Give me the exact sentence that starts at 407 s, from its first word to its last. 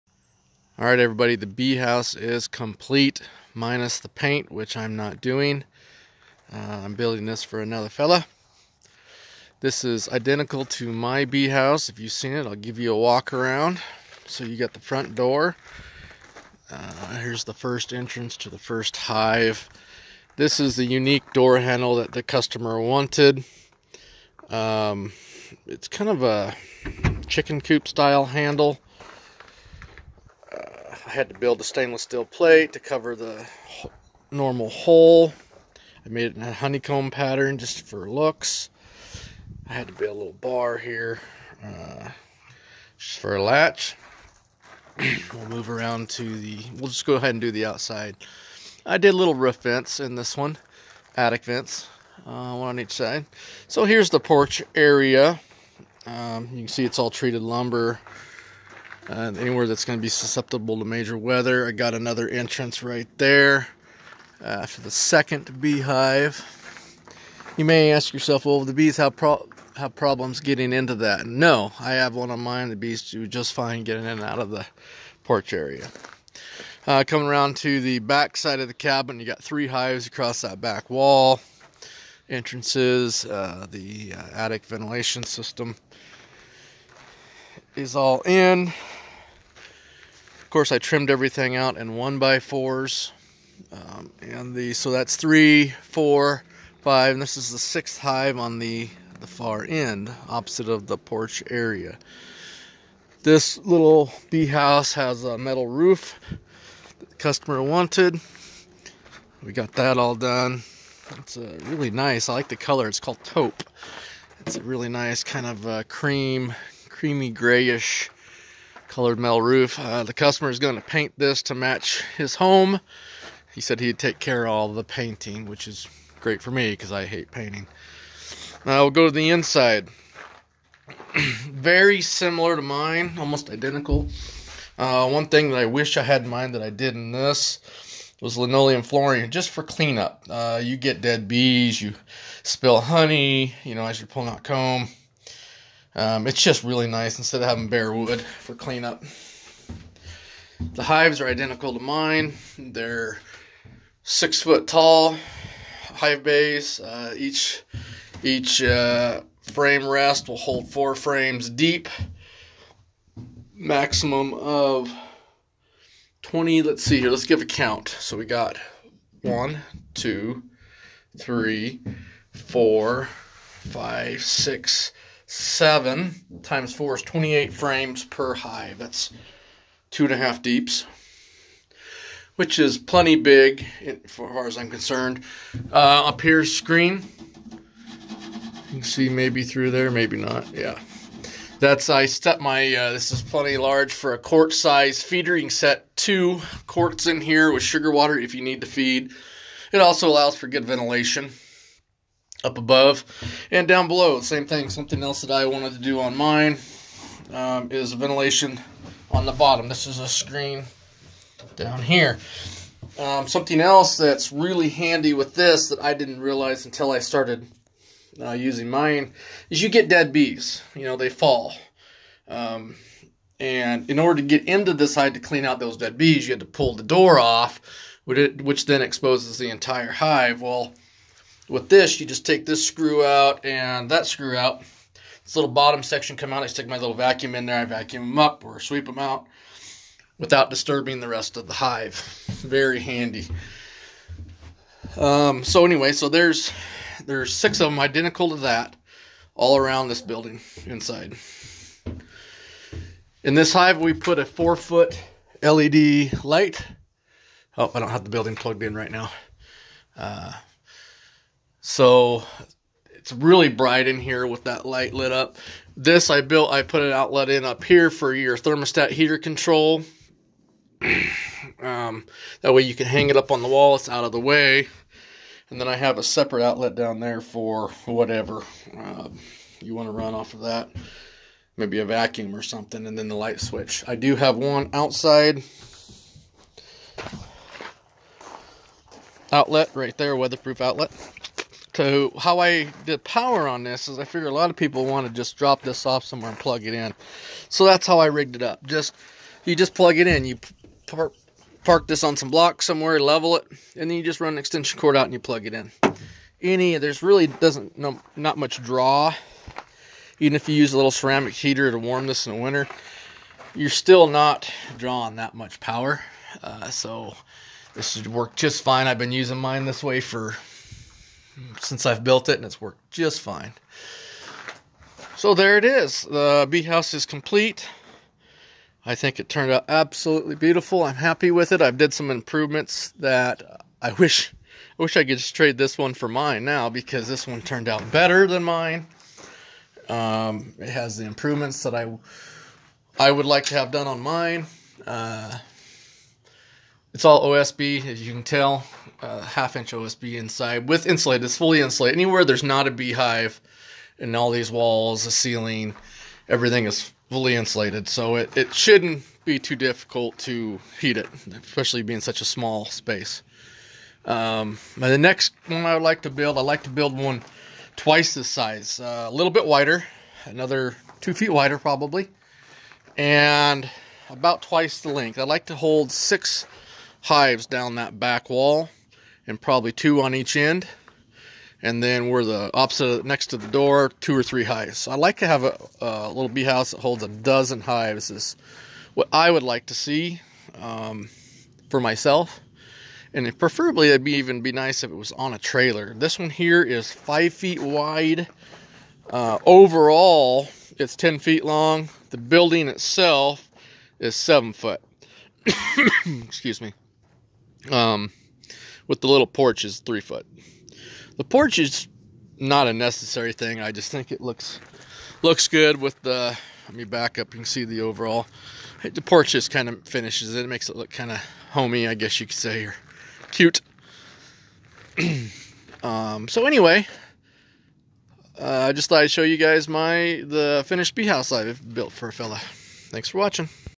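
Um, with the little porch is three foot.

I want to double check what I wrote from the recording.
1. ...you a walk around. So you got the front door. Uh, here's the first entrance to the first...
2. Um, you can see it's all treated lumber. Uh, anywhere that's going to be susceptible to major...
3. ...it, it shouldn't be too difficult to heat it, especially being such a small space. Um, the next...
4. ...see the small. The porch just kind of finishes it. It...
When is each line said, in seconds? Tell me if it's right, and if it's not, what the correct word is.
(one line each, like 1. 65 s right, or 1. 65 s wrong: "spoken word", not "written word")
1. 12 s right
2. 56 s right
3. 358 s right
4. 417 s wrong: "overall", not "small".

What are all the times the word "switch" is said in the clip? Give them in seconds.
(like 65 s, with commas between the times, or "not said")
283 s.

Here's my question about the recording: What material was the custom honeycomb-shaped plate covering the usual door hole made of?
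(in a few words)
stainless steel.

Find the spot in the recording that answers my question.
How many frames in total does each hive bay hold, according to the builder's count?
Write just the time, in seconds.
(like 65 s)
177 s.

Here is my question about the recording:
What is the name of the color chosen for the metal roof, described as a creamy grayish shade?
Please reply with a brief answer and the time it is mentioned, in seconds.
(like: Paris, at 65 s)
taupe, at 113 s.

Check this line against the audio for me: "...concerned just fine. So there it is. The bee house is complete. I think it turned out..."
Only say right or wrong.
wrong.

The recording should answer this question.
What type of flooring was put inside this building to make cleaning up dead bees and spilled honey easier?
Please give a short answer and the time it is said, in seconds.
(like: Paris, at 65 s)
linoleum, at 138 s.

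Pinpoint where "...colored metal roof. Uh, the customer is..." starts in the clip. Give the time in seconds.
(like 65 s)
118 s.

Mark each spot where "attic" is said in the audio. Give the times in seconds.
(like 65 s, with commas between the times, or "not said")
51 s, 84 s.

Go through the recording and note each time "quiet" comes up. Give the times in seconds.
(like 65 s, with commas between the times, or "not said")
not said.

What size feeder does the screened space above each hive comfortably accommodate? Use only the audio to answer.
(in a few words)
quart size.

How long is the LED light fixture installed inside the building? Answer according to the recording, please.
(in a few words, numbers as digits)
4 foot.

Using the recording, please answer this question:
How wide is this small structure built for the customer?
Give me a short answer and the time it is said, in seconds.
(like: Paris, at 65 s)
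5 feet, at 396 s.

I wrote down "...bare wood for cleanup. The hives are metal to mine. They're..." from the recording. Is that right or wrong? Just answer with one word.
wrong.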